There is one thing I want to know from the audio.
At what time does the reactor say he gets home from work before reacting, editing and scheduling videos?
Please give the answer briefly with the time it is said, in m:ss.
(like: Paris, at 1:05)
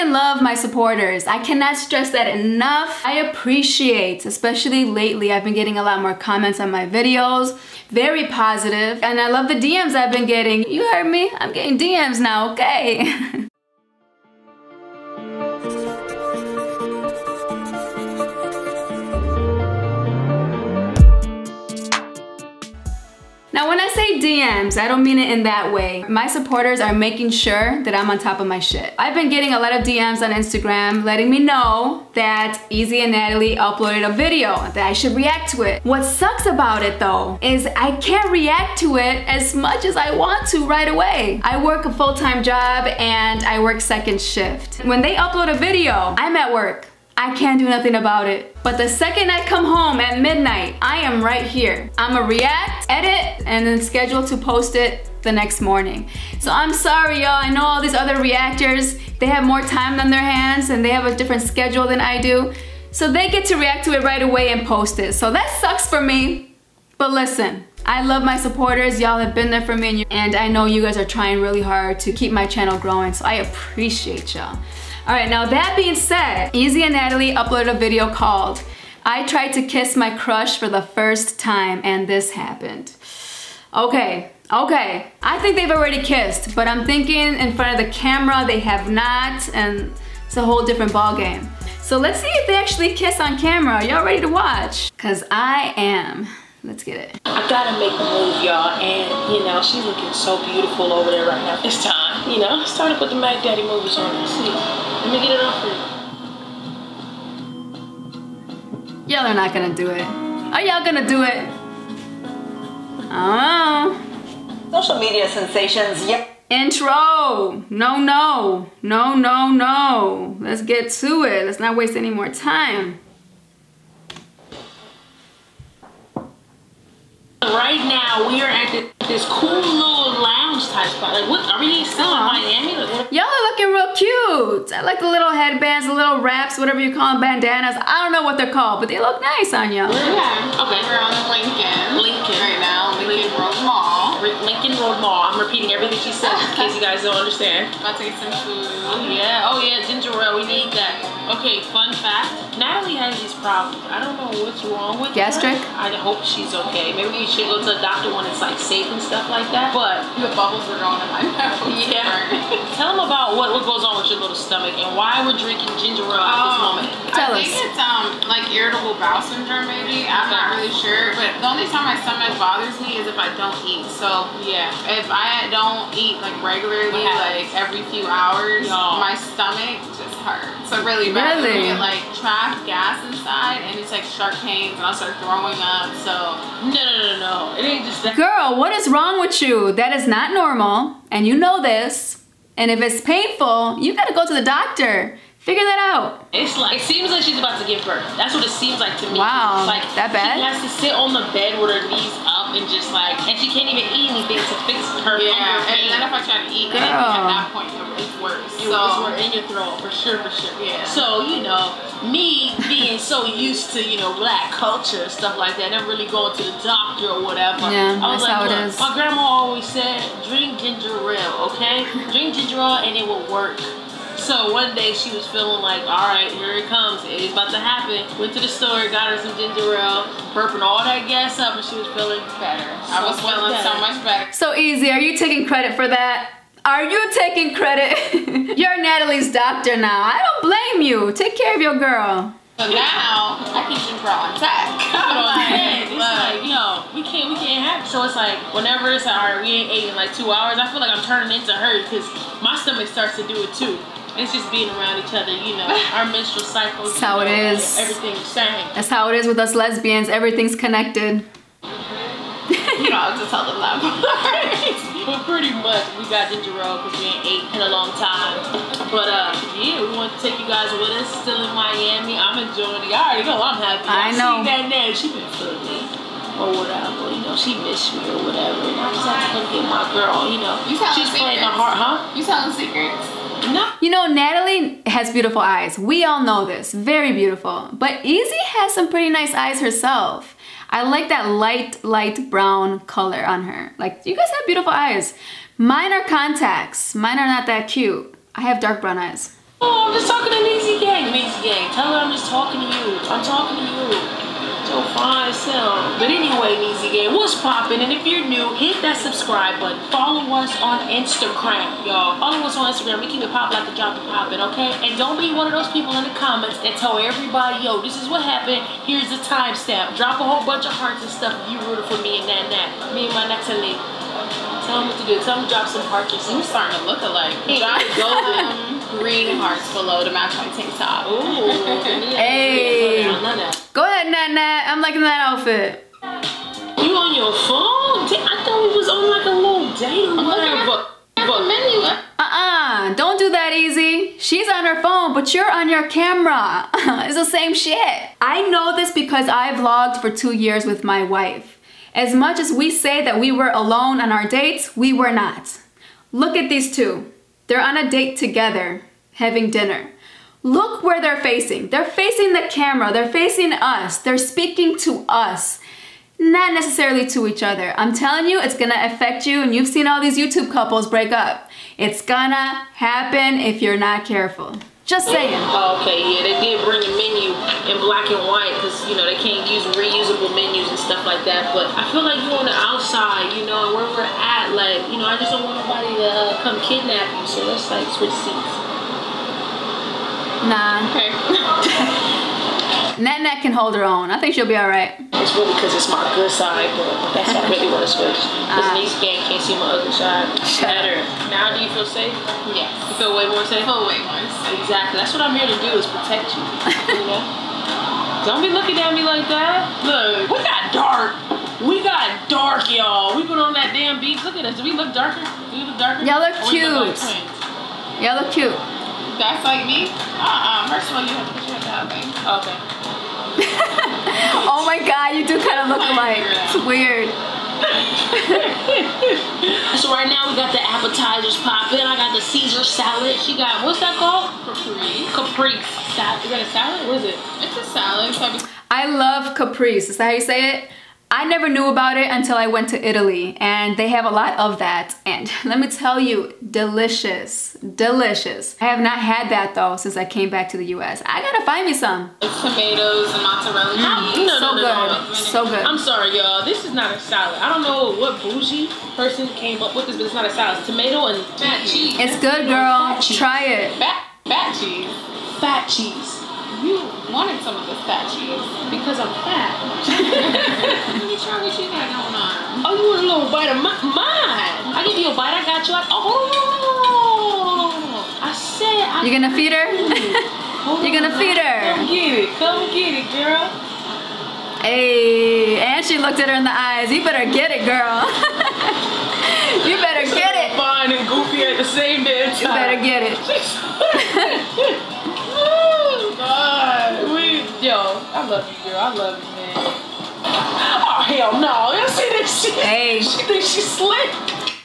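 Midnight, at 0:50.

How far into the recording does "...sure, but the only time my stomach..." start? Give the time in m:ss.
2:50.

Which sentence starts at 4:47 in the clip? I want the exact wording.
But Ezee has some pretty nice eyes herself.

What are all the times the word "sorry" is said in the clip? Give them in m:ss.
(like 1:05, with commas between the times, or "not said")
0:56, 7:35.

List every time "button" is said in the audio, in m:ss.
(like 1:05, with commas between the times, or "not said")
5:09.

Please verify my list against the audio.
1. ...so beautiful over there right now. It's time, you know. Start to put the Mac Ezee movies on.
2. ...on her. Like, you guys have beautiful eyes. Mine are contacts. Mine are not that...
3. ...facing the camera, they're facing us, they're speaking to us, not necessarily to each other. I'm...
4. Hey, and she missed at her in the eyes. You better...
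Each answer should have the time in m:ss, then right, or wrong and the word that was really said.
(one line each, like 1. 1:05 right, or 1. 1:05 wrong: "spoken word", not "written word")
1. 1:40 wrong: "Daddy", not "Ezee"
2. 4:53 right
3. 6:01 right
4. 8:04 wrong: "looked", not "missed".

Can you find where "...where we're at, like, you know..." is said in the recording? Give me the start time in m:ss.
6:23.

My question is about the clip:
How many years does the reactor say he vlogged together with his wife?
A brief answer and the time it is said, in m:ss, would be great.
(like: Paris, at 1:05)
2, at 5:50.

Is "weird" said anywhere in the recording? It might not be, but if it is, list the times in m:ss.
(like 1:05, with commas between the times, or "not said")
7:06.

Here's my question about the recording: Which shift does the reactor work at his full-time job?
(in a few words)
Second shift.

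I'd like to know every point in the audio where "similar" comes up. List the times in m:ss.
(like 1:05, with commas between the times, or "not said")
not said.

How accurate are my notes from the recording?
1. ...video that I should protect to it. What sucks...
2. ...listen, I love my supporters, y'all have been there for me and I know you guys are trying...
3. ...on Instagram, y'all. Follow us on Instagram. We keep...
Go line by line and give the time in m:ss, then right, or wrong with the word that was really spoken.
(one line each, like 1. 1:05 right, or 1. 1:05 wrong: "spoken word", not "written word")
1. 0:34 wrong: "react", not "protect"
2. 1:07 right
3. 5:10 right.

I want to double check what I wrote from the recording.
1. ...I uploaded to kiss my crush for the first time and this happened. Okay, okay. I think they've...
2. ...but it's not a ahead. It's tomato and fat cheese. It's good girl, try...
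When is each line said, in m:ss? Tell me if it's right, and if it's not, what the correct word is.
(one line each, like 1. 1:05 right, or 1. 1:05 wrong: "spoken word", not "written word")
1. 1:19 wrong: "tried", not "uploaded"
2. 7:39 wrong: "salad", not "ahead".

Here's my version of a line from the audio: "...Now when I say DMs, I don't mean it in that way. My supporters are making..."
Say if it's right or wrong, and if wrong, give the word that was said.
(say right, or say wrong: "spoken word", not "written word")
right.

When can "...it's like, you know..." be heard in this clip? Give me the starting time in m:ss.
4:05.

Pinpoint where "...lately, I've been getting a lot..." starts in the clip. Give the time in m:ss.
0:04.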